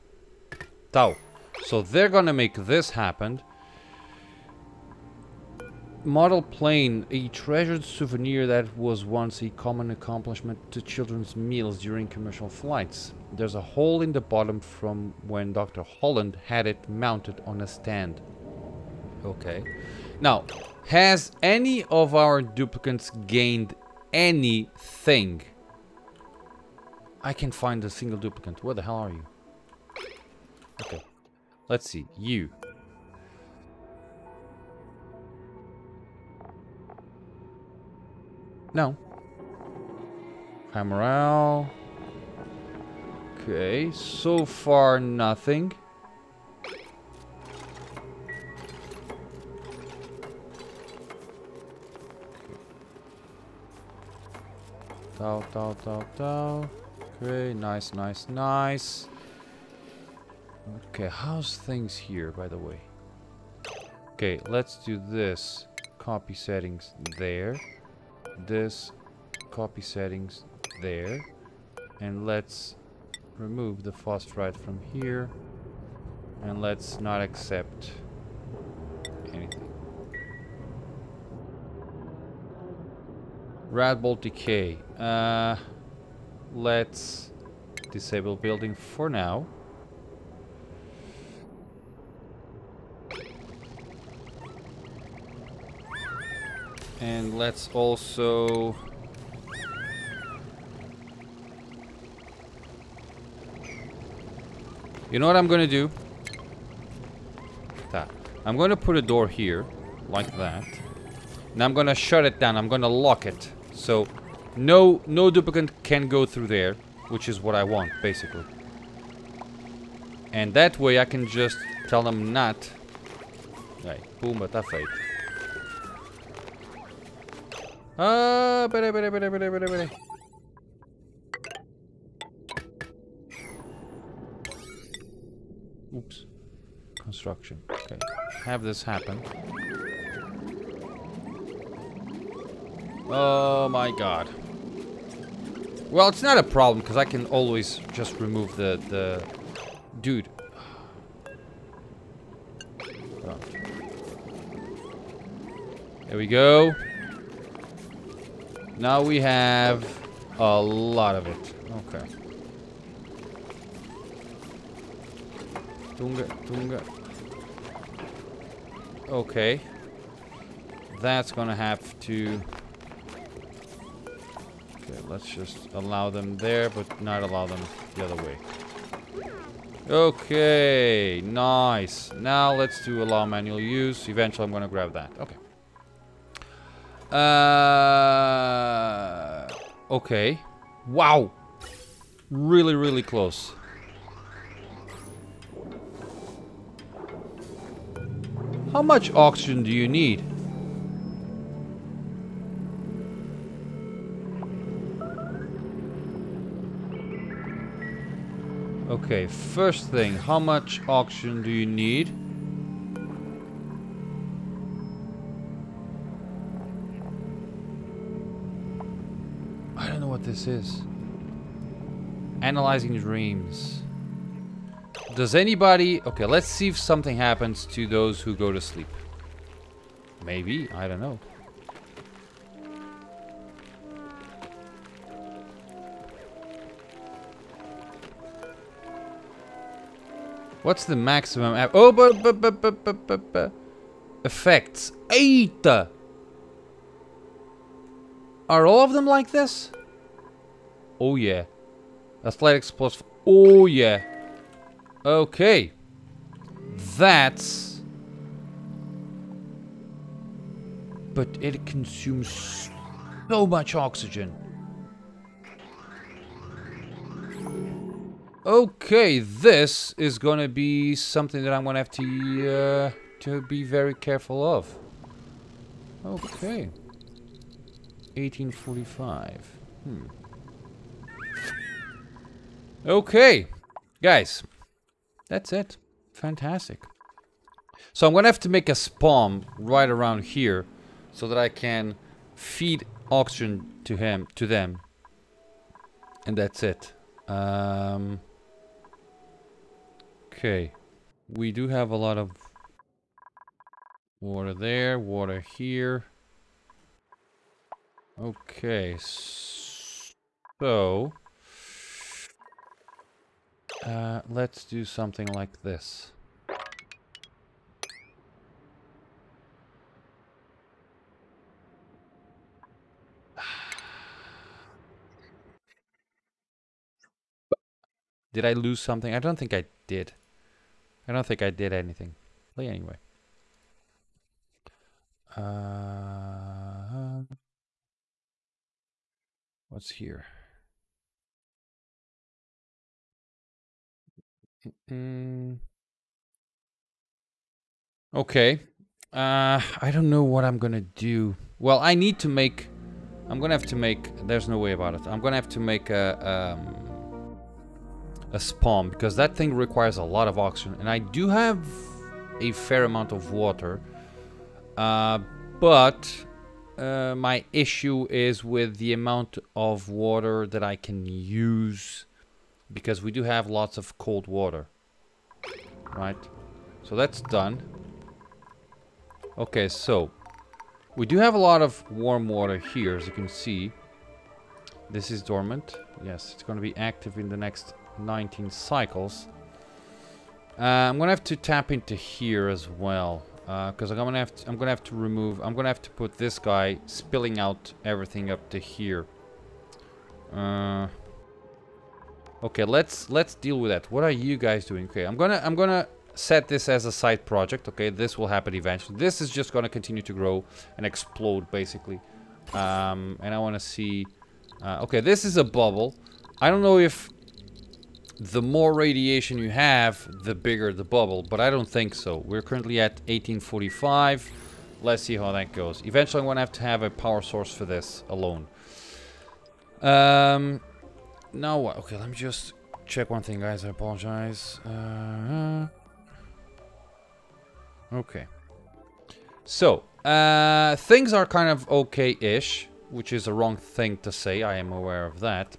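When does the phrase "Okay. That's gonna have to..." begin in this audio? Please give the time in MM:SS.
02:49.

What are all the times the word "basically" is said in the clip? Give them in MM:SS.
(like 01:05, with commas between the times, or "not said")
01:58, 06:51.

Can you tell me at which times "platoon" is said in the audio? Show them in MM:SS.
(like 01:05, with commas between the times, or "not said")
not said.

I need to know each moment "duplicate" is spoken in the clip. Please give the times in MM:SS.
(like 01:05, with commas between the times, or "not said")
00:22, 00:28, 01:55.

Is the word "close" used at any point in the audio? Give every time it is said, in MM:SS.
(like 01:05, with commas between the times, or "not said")
03:13.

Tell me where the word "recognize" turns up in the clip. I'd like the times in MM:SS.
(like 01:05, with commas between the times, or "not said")
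not said.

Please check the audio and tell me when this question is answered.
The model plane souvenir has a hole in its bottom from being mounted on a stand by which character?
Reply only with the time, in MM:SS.
00:15.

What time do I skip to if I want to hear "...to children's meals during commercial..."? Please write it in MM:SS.
00:10.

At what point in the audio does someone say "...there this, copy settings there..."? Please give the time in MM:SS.
01:07.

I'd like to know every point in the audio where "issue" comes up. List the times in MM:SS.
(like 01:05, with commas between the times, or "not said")
06:07.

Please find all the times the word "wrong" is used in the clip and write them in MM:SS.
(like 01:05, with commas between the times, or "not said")
07:23.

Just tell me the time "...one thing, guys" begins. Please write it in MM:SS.
07:13.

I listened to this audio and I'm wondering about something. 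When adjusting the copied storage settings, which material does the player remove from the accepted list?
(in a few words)
phosphorite.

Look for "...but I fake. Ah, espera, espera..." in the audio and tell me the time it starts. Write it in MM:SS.
02:04.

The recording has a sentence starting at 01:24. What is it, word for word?
Uh, let's disable building for now.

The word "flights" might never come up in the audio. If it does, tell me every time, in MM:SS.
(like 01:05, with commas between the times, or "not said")
00:12.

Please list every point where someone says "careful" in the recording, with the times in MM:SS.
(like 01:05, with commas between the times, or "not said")
04:33.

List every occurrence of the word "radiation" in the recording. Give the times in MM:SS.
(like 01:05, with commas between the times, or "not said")
06:58.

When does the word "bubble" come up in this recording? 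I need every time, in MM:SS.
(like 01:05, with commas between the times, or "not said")
06:55, 07:00.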